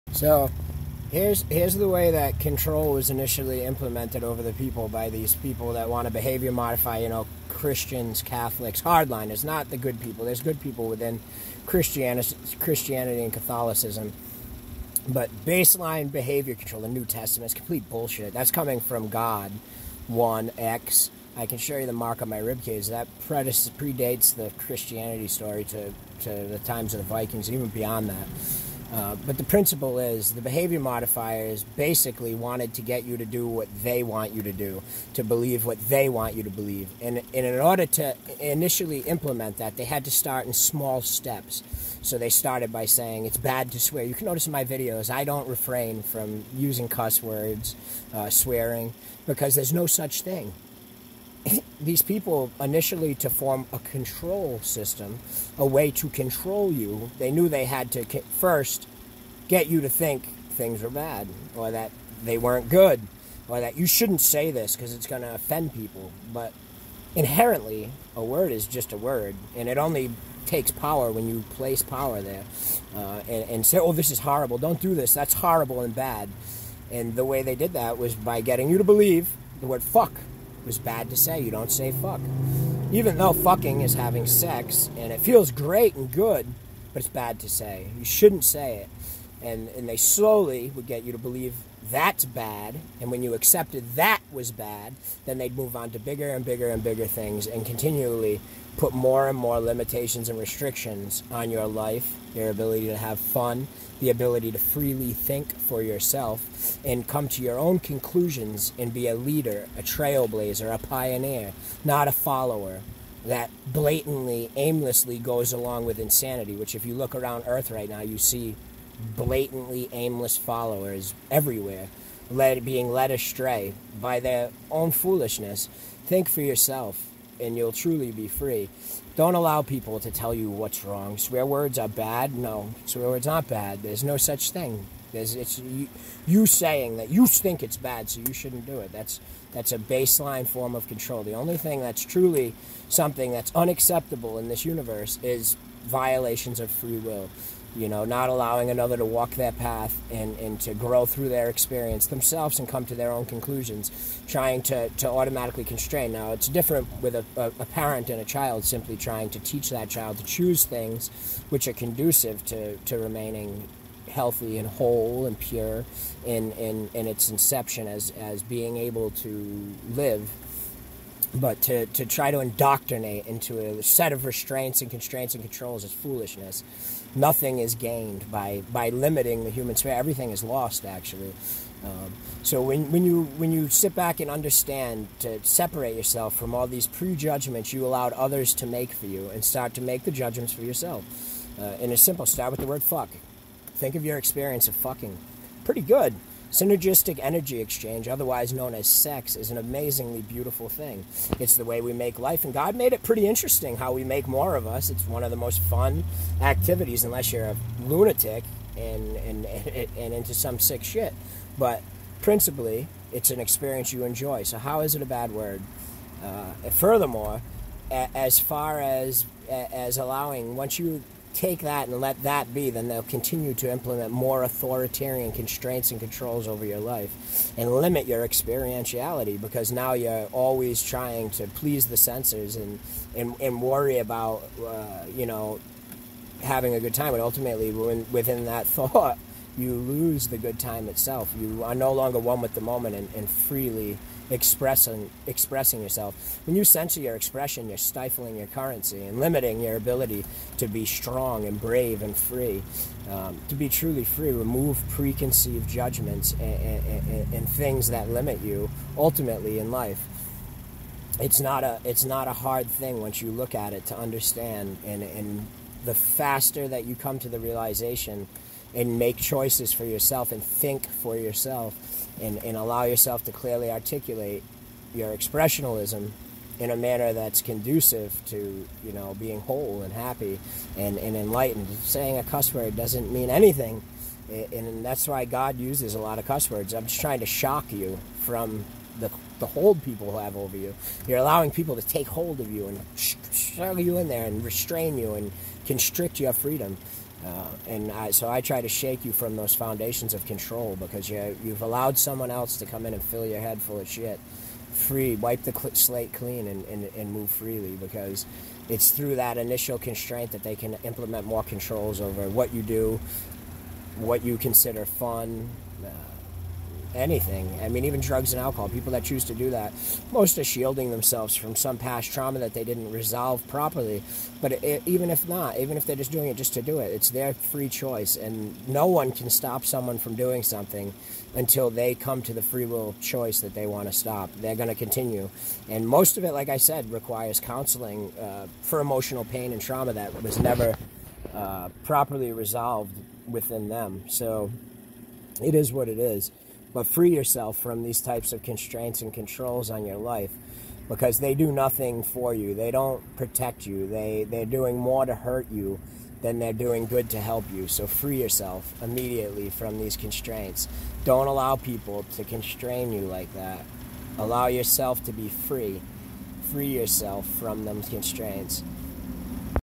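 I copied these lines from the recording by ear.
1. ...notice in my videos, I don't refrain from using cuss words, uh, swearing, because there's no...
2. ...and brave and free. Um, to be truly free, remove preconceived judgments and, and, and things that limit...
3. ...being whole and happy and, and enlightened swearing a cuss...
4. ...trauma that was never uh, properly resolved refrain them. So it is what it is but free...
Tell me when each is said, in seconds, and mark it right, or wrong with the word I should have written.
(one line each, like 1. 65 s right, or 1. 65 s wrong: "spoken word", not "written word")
1. 44 s right
2. 251 s right
3. 279 s wrong: "saying", not "swearing"
4. 339 s wrong: "within", not "refrain".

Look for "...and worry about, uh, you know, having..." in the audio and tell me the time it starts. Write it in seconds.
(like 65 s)
233 s.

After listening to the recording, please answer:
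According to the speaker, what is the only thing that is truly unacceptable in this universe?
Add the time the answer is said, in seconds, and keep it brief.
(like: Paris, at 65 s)
violations of free will, at 145 s.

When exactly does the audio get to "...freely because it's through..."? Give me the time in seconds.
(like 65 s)
307 s.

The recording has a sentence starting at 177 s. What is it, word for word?
Nothing is gained by, by limiting the human spirit.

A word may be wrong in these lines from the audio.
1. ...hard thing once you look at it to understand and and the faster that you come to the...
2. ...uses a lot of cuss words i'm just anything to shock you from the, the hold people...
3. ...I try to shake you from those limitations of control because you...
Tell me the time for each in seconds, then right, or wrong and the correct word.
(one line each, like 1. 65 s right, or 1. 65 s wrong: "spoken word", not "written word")
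1. 262 s right
2. 285 s wrong: "trying", not "anything"
3. 298 s wrong: "foundations", not "limitations".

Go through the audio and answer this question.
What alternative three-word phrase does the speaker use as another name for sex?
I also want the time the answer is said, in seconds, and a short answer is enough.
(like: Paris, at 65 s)
Synergistic energy exchange, at 196 s.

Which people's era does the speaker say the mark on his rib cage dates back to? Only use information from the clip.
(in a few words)
Vikings.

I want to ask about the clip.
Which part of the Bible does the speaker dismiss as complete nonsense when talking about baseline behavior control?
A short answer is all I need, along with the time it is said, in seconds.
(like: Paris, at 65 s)
New Testament, at 16 s.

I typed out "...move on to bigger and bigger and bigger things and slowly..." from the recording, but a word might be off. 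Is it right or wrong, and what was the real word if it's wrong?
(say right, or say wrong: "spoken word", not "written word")
wrong: "continually", not "slowly".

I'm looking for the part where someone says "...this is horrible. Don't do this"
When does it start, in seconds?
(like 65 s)
73 s.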